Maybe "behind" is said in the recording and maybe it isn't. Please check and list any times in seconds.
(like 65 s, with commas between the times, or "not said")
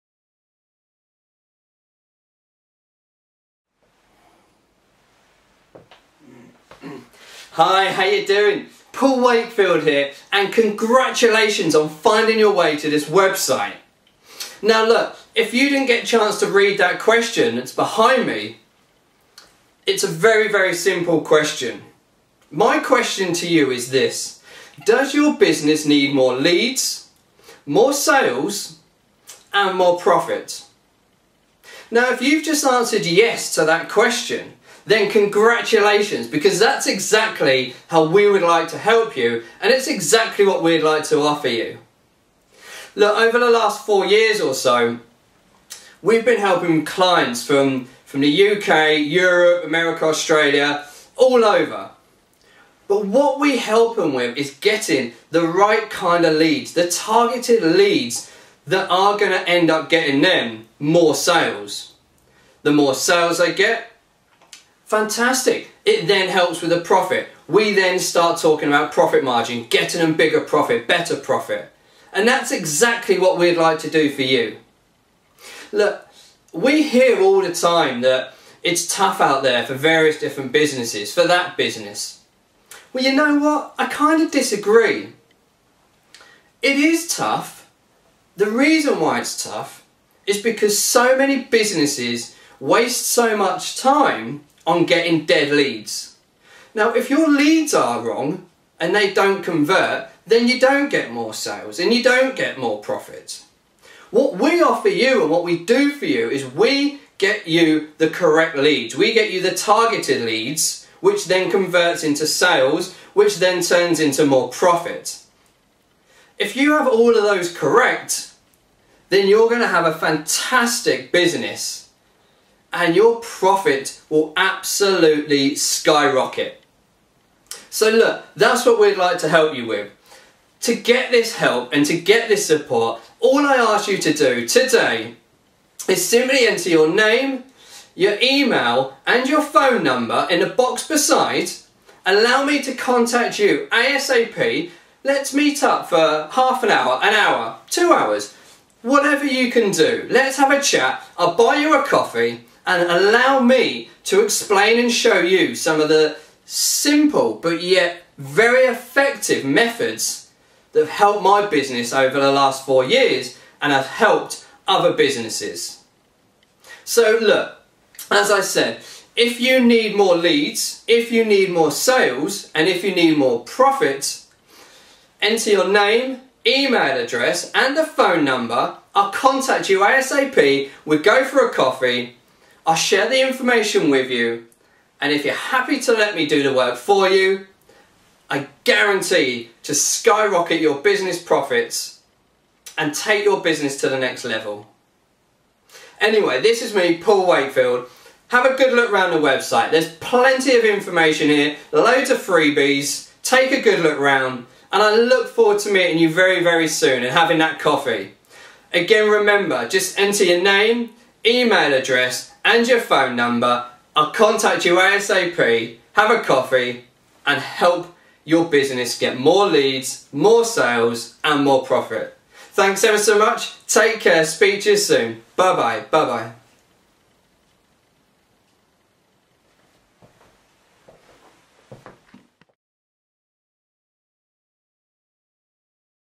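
17 s.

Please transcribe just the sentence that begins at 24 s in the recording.
Does your business need more leads, more sales and more profit?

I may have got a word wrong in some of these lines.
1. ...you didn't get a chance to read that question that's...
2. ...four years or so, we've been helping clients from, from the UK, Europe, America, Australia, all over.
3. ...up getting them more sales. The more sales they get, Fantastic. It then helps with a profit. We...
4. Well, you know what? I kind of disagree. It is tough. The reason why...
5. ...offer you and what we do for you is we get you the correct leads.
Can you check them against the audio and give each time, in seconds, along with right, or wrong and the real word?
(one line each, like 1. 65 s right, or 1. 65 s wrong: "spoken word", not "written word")
1. 15 s right
2. 43 s right
3. 59 s right
4. 82 s right
5. 104 s right.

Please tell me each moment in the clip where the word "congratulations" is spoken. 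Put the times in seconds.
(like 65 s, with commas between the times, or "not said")
10 s, 35 s.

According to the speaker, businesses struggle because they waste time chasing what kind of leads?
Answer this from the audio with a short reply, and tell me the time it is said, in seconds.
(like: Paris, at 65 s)
Dead leads, at 95 s.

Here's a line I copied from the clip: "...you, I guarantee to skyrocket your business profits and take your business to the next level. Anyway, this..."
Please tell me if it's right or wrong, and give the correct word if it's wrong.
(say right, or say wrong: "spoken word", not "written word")
right.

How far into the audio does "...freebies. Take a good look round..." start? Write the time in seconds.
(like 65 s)
202 s.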